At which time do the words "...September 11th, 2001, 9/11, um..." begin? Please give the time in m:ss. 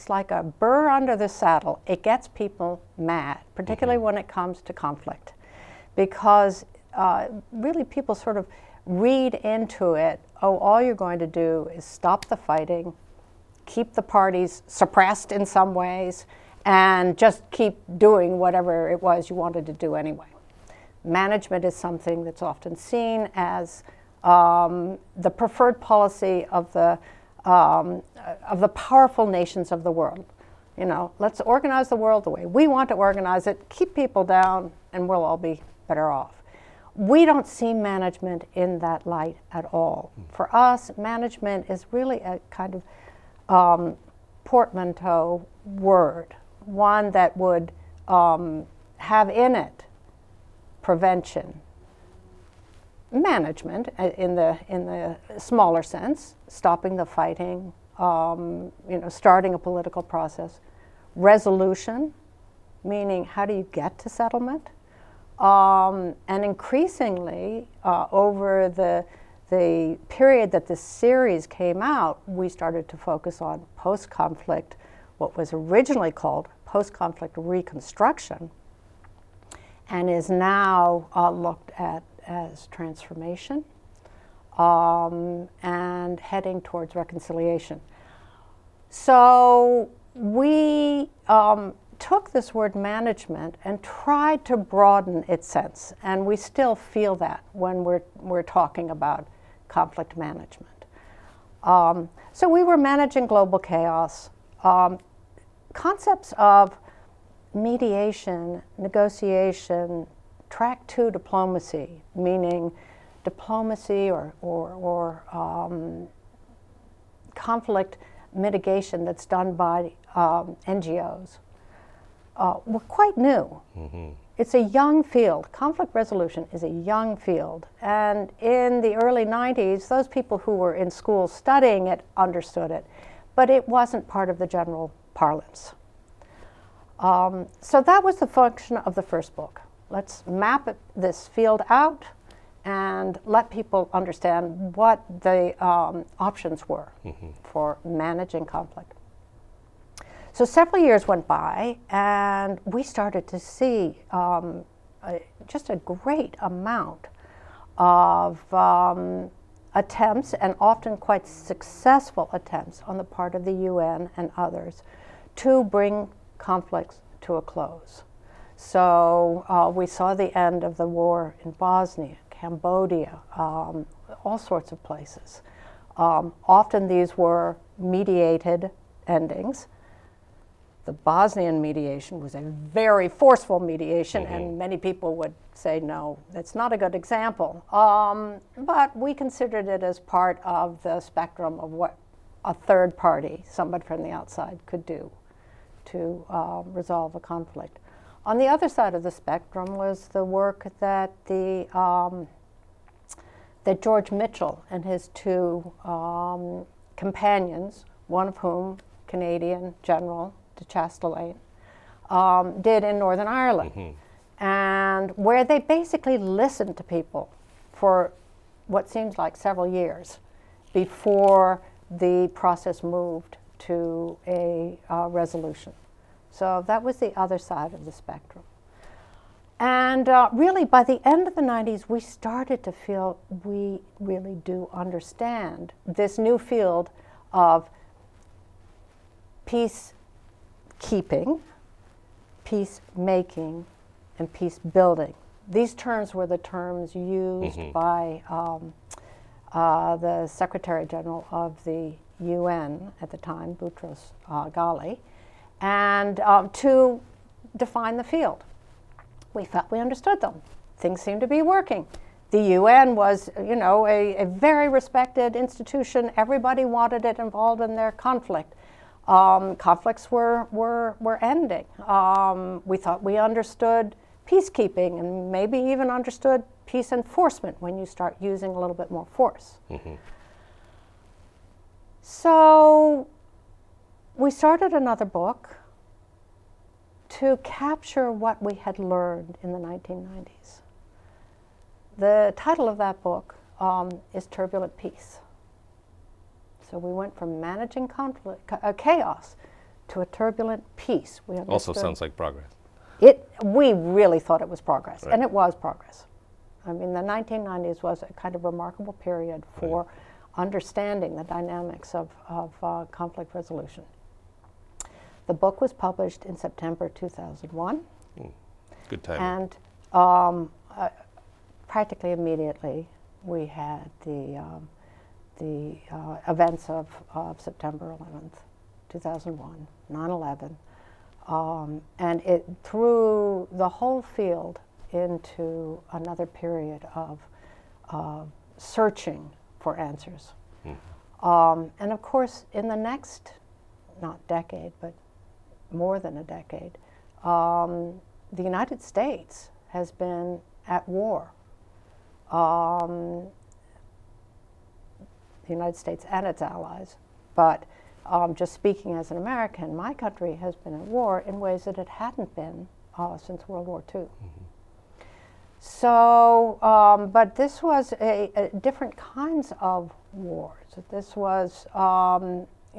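5:27.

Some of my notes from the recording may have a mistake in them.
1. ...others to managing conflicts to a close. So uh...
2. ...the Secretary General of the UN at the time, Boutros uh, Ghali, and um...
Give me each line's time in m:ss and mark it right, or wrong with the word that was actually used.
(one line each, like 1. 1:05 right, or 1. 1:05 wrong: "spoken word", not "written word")
1. 2:44 wrong: "bring", not "managing"
2. 4:10 right.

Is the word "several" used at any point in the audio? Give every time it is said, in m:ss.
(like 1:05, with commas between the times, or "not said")
2:30, 3:39.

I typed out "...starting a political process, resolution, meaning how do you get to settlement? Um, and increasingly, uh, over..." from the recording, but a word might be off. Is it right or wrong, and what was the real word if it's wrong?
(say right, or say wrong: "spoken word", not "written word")
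right.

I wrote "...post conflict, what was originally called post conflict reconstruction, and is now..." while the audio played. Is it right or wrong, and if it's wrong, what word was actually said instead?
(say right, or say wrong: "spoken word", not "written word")
right.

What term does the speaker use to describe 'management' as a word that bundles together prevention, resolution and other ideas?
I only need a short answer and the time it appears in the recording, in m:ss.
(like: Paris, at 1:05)
portmanteau word, at 0:44.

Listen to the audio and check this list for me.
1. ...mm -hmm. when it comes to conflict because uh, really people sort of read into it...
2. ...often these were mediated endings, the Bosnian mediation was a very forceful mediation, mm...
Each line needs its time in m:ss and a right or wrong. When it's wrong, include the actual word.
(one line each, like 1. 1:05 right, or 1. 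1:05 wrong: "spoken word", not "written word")
1. 0:03 right
2. 2:56 right.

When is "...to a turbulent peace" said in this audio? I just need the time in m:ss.
4:59.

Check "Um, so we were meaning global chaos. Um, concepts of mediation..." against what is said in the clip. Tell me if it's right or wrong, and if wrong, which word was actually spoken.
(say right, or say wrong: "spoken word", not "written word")
wrong: "managing", not "meaning".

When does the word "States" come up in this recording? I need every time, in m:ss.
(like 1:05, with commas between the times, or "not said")
5:48, 5:55.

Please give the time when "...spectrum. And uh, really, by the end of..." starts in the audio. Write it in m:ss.
3:47.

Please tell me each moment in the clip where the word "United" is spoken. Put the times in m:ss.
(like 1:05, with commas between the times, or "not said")
5:48, 5:55.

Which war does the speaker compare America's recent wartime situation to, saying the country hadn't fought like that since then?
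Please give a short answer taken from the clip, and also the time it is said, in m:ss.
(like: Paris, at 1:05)
World War II, at 6:03.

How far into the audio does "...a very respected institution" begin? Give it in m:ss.
4:24.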